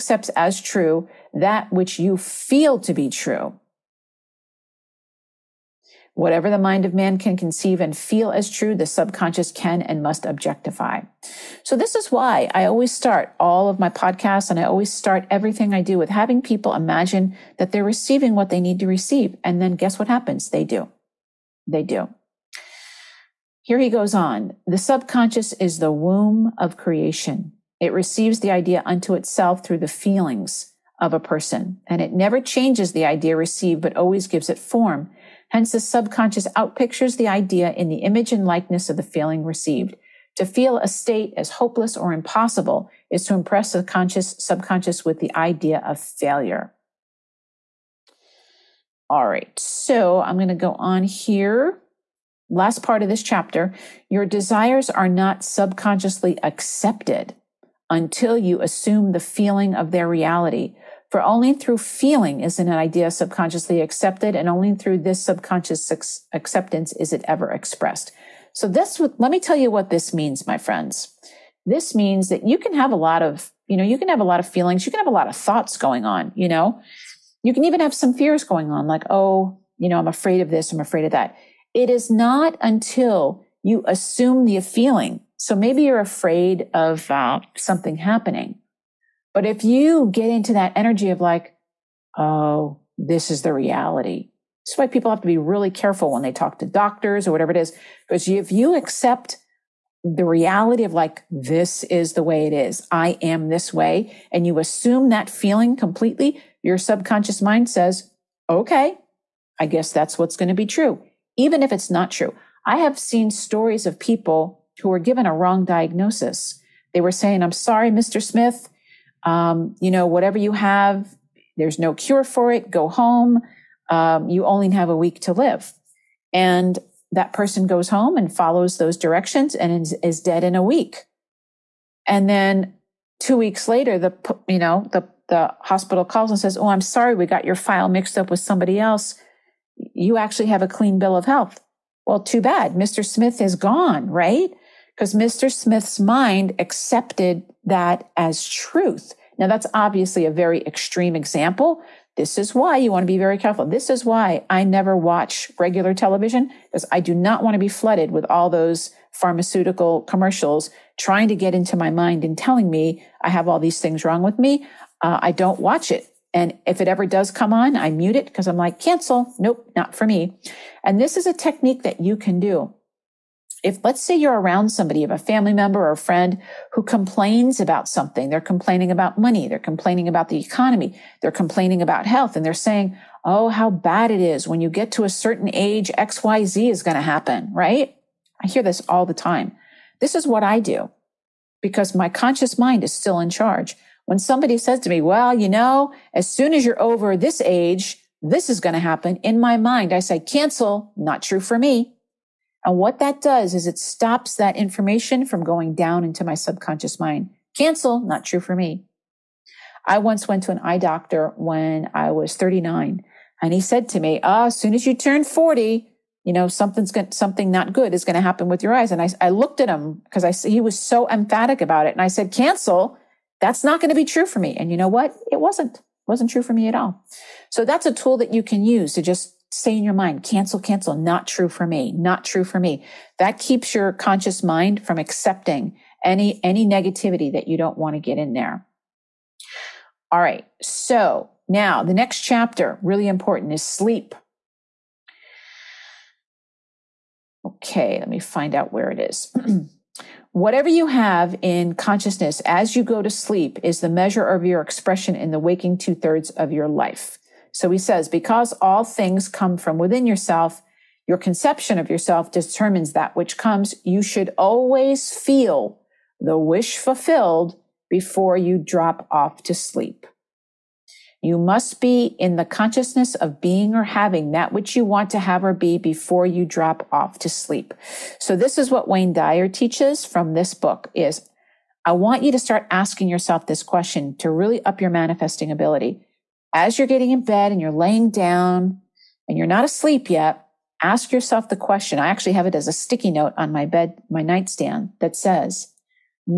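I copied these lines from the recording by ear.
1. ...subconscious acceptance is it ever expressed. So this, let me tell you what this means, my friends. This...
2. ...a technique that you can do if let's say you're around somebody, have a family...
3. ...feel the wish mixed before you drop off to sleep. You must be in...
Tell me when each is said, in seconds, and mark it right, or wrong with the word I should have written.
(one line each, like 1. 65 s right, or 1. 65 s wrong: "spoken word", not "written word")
1. 65 s right
2. 171 s right
3. 265 s wrong: "fulfilled", not "mixed".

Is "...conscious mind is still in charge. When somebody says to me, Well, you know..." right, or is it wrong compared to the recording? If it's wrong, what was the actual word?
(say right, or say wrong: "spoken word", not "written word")
right.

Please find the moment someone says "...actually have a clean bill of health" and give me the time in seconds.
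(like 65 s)
140 s.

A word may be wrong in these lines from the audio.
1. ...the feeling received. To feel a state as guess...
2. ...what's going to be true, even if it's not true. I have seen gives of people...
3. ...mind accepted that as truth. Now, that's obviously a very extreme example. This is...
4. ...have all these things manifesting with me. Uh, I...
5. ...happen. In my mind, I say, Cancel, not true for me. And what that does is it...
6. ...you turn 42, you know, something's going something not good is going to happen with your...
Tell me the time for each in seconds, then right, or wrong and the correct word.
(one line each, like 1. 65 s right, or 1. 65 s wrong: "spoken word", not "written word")
1. 38 s wrong: "hopeless", not "guess"
2. 110 s wrong: "stories", not "gives"
3. 145 s right
4. 163 s wrong: "wrong", not "manifesting"
5. 198 s right
6. 214 s wrong: "40", not "42".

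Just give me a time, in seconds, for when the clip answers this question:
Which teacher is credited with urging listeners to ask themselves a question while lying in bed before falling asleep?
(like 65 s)
278 s.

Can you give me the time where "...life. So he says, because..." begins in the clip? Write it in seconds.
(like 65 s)
256 s.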